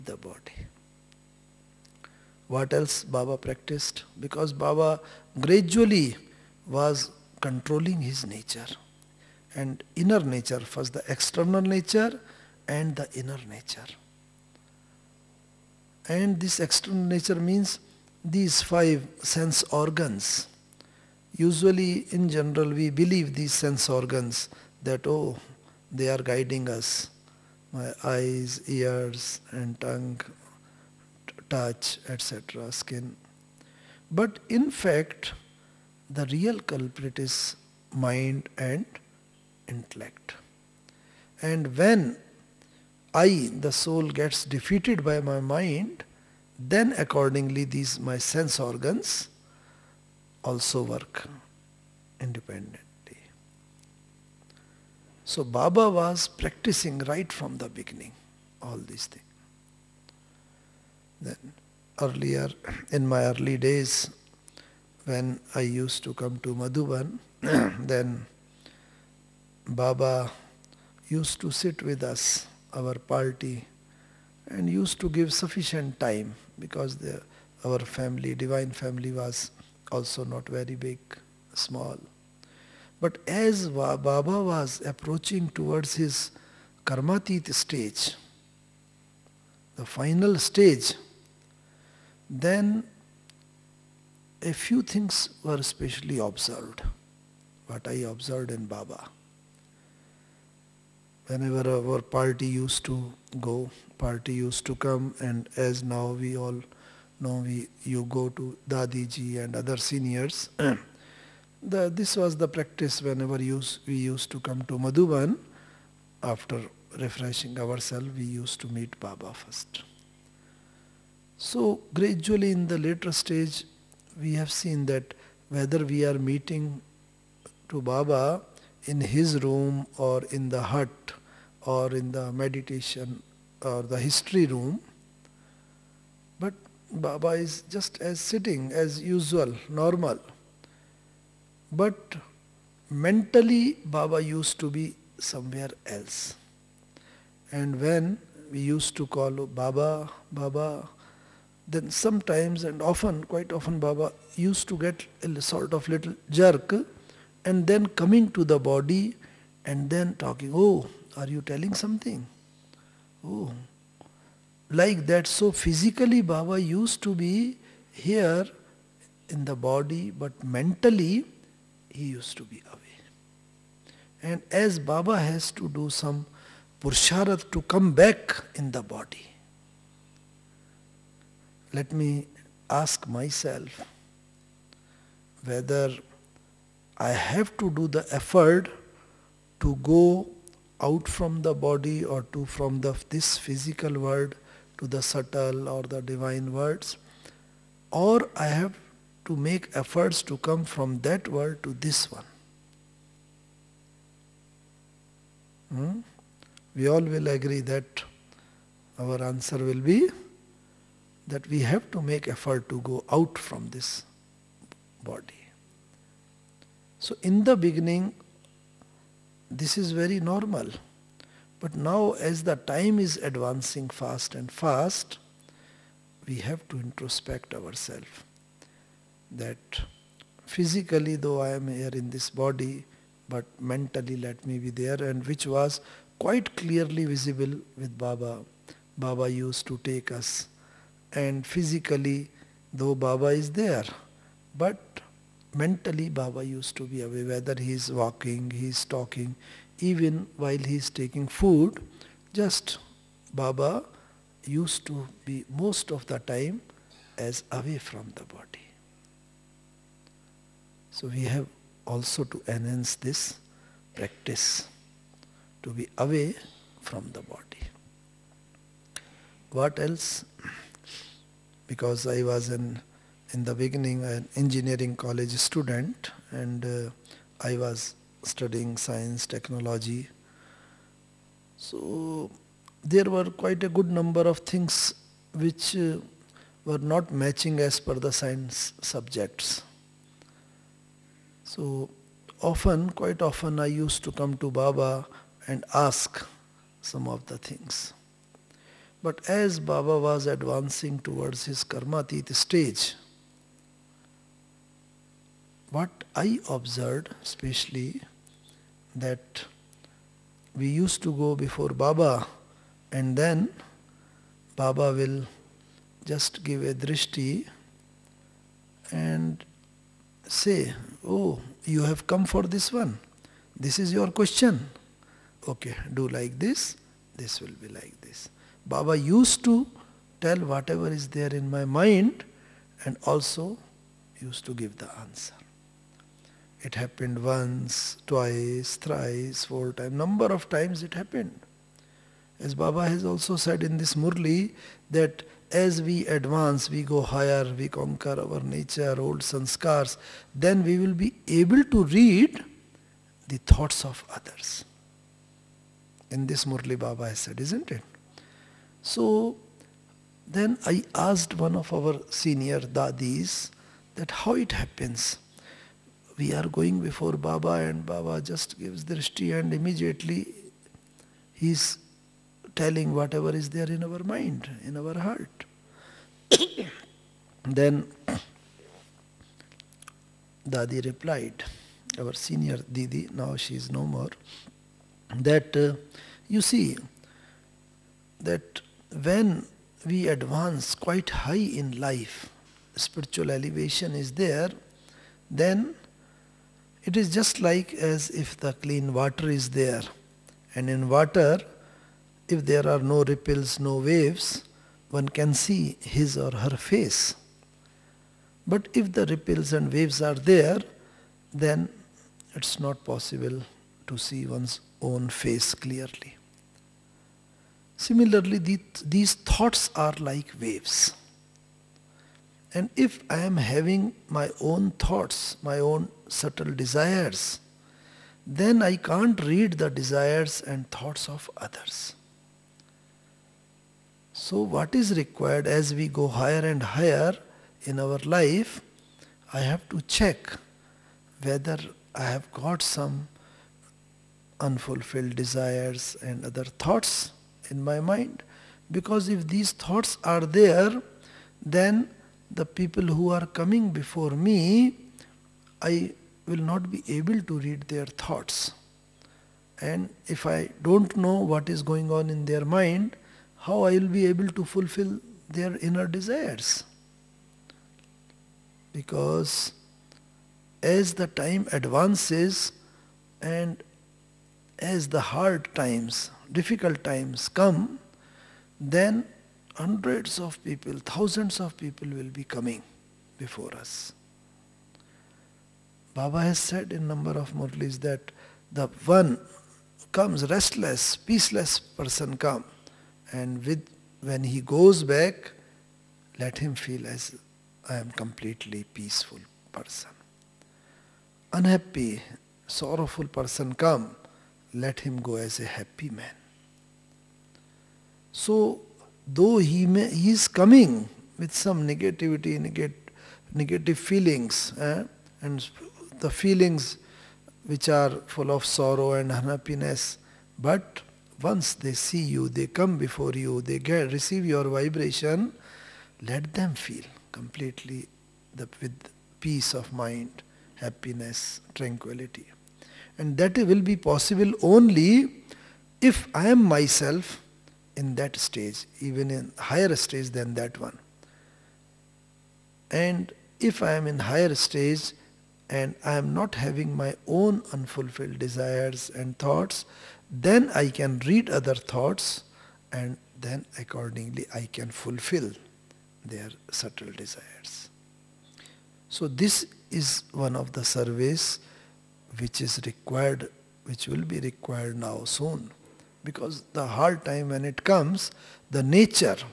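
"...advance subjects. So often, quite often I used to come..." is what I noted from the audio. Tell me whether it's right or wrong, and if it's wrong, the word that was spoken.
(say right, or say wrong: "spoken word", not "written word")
wrong: "science", not "advance".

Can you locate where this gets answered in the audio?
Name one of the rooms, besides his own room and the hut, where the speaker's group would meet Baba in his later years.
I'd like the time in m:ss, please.
2:14.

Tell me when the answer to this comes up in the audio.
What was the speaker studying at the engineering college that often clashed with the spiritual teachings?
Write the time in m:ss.
4:38.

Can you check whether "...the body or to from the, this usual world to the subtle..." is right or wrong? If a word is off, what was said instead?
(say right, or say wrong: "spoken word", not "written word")
wrong: "physical", not "usual".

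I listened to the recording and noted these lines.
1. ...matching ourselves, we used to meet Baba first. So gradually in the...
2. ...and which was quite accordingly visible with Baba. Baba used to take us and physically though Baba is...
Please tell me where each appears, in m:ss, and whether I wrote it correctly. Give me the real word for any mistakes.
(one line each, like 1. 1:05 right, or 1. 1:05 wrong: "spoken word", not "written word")
1. 1:56 wrong: "refreshing", not "matching"
2. 3:55 wrong: "clearly", not "accordingly".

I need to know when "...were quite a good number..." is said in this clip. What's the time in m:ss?
4:43.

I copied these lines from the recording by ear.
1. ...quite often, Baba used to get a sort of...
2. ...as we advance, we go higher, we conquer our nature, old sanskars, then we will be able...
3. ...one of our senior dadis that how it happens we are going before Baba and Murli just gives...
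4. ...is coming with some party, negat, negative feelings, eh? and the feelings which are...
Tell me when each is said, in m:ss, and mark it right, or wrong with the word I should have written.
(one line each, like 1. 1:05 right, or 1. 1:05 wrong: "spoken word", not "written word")
1. 2:33 right
2. 5:45 right
3. 6:01 wrong: "Baba", not "Murli"
4. 8:30 wrong: "negativity", not "party".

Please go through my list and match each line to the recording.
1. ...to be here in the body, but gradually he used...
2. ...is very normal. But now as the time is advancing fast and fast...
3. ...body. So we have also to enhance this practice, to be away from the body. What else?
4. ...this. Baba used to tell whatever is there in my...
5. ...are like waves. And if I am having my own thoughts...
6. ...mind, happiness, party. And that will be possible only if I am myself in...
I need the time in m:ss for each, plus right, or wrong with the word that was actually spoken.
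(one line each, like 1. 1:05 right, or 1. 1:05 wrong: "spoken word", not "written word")
1. 2:47 wrong: "mentally", not "gradually"
2. 3:39 right
3. 4:18 right
4. 5:28 right
5. 6:59 right
6. 8:49 wrong: "tranquility", not "party".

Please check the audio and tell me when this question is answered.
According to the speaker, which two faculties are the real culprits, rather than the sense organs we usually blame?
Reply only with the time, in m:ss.
0:37.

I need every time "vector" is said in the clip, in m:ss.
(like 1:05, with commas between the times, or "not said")
not said.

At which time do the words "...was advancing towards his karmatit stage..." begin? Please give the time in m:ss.
4:59.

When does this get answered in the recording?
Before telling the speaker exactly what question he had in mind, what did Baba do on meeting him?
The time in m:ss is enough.
5:16.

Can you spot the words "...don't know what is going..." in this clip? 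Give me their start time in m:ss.
7:40.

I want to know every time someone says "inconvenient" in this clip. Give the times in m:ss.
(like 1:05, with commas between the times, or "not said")
not said.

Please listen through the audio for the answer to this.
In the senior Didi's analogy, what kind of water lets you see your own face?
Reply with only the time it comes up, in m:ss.
6:38.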